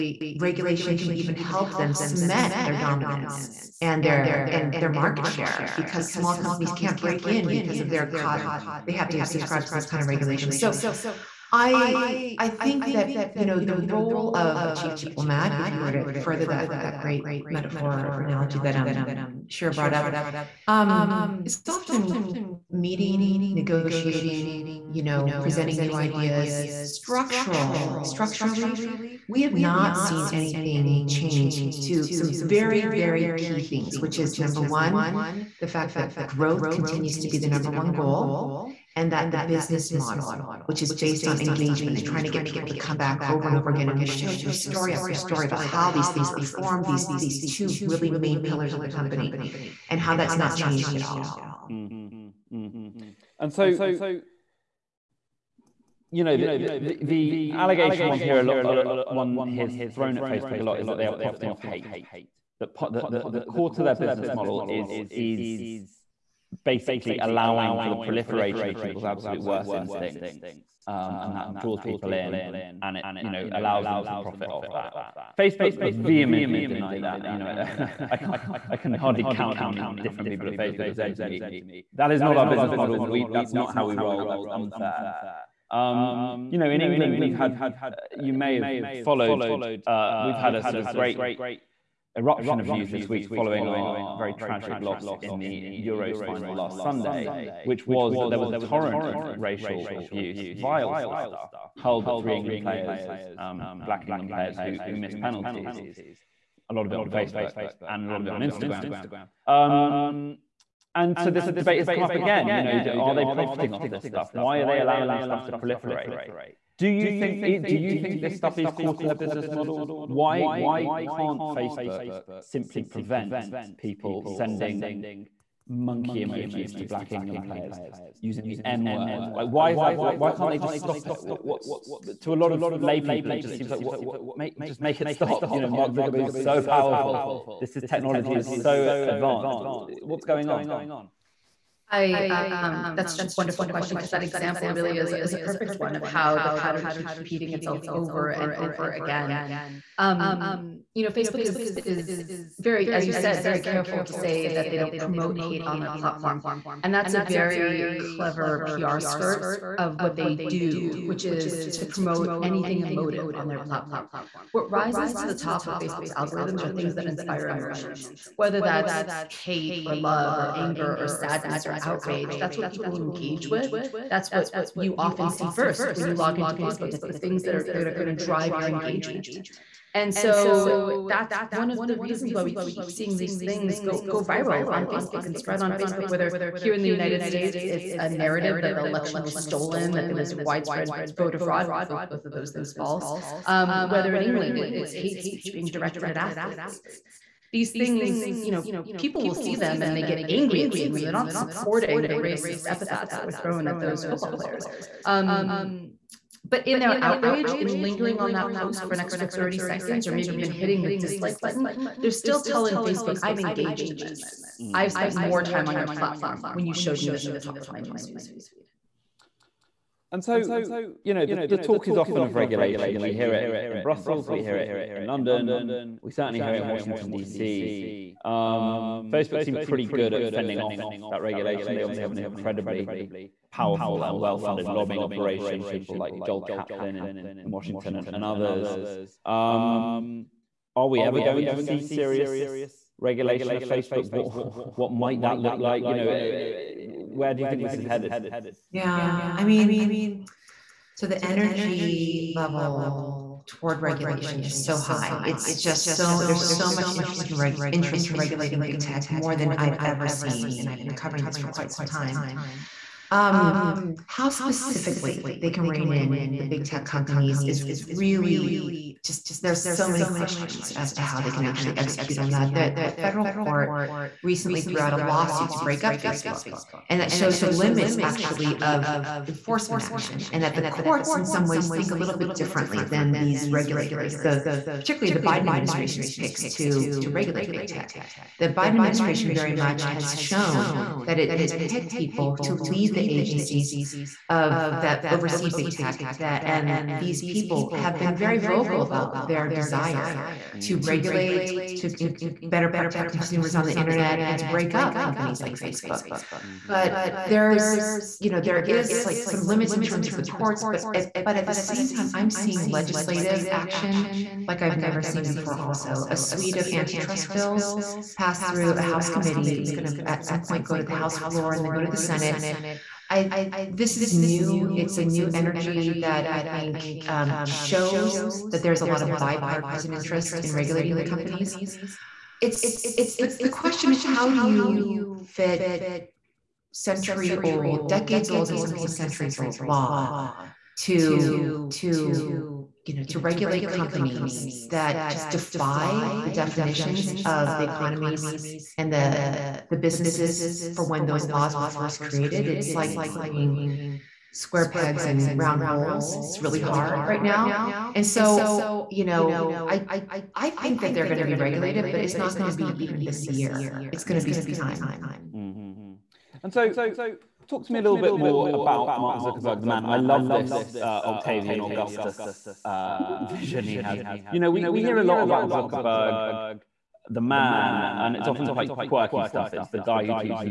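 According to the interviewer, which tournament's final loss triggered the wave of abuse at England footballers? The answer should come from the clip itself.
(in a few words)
Euros final.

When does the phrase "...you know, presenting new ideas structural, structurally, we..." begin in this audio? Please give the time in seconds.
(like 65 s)
24 s.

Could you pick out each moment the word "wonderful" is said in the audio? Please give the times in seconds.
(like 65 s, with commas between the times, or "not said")
143 s.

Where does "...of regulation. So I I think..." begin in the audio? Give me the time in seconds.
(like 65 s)
10 s.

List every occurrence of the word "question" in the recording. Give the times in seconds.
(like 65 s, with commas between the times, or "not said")
143 s, 270 s, 333 s.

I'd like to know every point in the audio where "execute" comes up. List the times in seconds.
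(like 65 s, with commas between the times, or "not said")
271 s.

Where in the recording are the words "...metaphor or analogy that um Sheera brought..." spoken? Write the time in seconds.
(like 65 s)
17 s.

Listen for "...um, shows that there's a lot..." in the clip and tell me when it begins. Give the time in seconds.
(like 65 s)
327 s.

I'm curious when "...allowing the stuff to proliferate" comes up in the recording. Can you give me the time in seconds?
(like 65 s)
114 s.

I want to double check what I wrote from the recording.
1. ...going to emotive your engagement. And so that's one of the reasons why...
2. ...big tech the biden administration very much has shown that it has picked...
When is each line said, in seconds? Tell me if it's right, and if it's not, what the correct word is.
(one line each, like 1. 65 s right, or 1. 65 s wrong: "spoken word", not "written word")
1. 177 s wrong: "drive", not "emotive"
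2. 287 s right.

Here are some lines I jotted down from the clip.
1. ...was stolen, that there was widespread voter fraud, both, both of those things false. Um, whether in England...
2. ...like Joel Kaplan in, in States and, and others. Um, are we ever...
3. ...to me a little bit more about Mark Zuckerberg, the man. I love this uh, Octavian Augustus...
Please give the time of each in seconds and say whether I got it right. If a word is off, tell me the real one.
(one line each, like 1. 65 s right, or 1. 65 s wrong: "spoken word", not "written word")
1. 189 s right
2. 235 s wrong: "Washington", not "States"
3. 367 s right.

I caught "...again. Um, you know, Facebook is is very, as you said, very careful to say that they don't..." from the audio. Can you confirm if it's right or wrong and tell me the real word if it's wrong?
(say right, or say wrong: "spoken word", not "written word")
right.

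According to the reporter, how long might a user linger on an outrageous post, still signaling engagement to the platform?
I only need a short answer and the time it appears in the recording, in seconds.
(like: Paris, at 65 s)
30 seconds, at 209 s.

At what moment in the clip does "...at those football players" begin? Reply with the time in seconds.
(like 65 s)
203 s.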